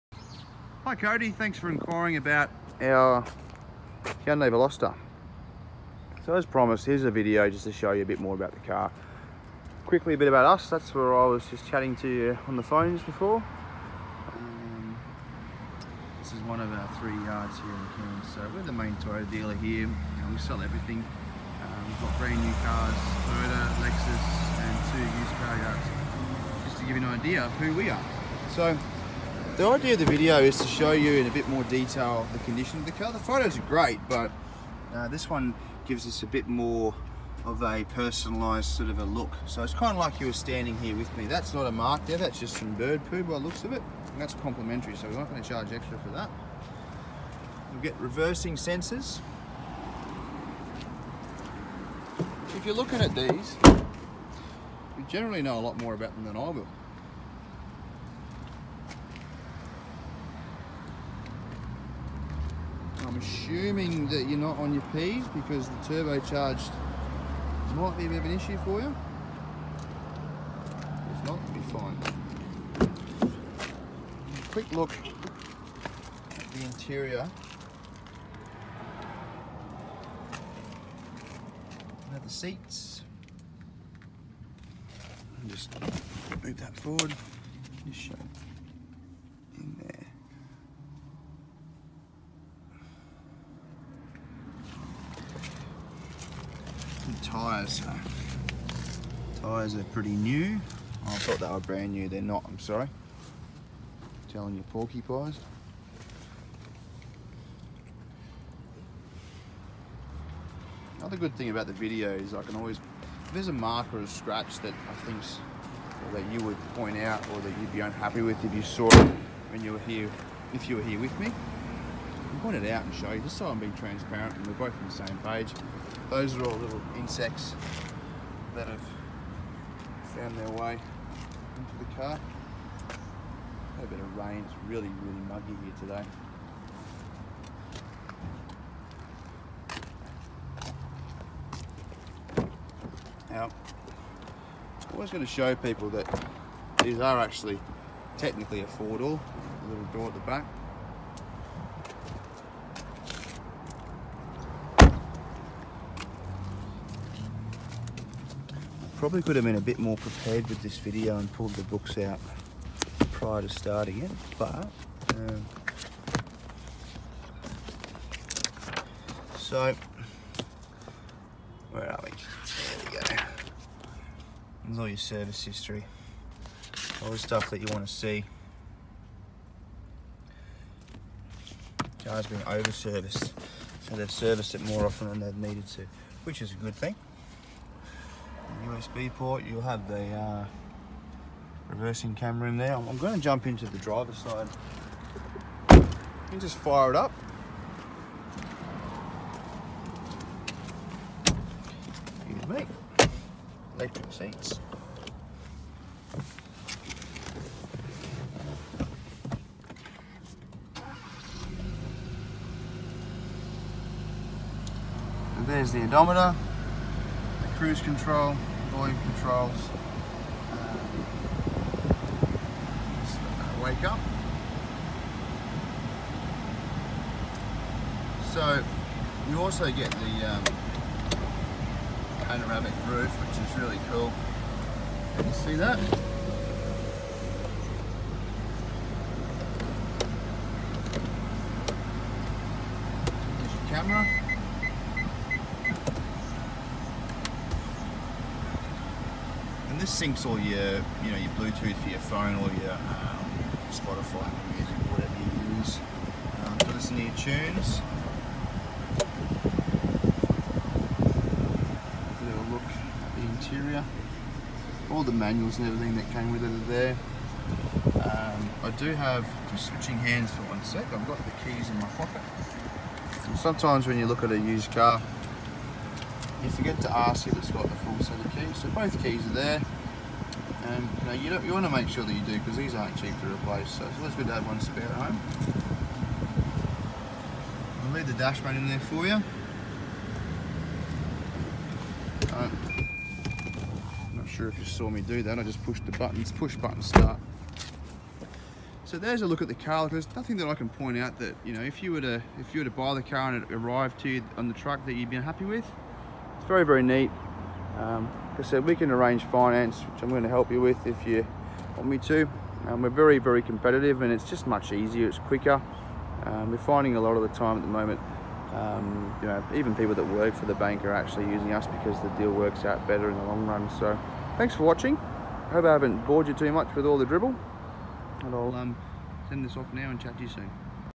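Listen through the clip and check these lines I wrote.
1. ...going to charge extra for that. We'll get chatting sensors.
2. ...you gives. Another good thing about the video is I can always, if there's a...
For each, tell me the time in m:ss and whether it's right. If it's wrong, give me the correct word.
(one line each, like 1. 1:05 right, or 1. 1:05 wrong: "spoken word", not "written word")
1. 0:45 wrong: "reversing", not "chatting"
2. 1:44 wrong: "porcupines", not "gives".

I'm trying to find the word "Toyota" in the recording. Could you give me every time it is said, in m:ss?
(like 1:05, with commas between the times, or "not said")
0:18, 0:23.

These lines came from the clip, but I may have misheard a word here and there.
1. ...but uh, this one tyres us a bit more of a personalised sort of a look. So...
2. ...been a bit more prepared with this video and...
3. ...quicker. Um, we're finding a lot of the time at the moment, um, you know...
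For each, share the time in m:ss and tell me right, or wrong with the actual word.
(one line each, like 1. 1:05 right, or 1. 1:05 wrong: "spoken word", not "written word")
1. 0:34 wrong: "gives", not "tyres"
2. 2:39 right
3. 5:15 right.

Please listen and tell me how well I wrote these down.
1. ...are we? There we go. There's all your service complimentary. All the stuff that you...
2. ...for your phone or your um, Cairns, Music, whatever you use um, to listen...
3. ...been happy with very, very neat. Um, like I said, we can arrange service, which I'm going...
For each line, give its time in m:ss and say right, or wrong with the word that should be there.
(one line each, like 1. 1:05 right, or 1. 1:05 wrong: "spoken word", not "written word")
1. 2:51 wrong: "history", not "complimentary"
2. 4:11 wrong: "Spotify", not "Cairns"
3. 5:05 wrong: "finance", not "service".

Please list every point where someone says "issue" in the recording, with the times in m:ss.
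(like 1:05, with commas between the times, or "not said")
1:08.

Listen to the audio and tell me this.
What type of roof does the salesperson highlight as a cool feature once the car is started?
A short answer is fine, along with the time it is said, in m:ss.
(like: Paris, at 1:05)
panoramic roof, at 3:52.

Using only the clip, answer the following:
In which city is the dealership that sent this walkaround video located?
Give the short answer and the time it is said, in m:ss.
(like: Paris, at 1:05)
Cairns, at 0:17.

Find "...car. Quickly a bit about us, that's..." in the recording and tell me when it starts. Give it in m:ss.
0:08.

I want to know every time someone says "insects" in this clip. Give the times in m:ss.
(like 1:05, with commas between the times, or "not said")
2:06.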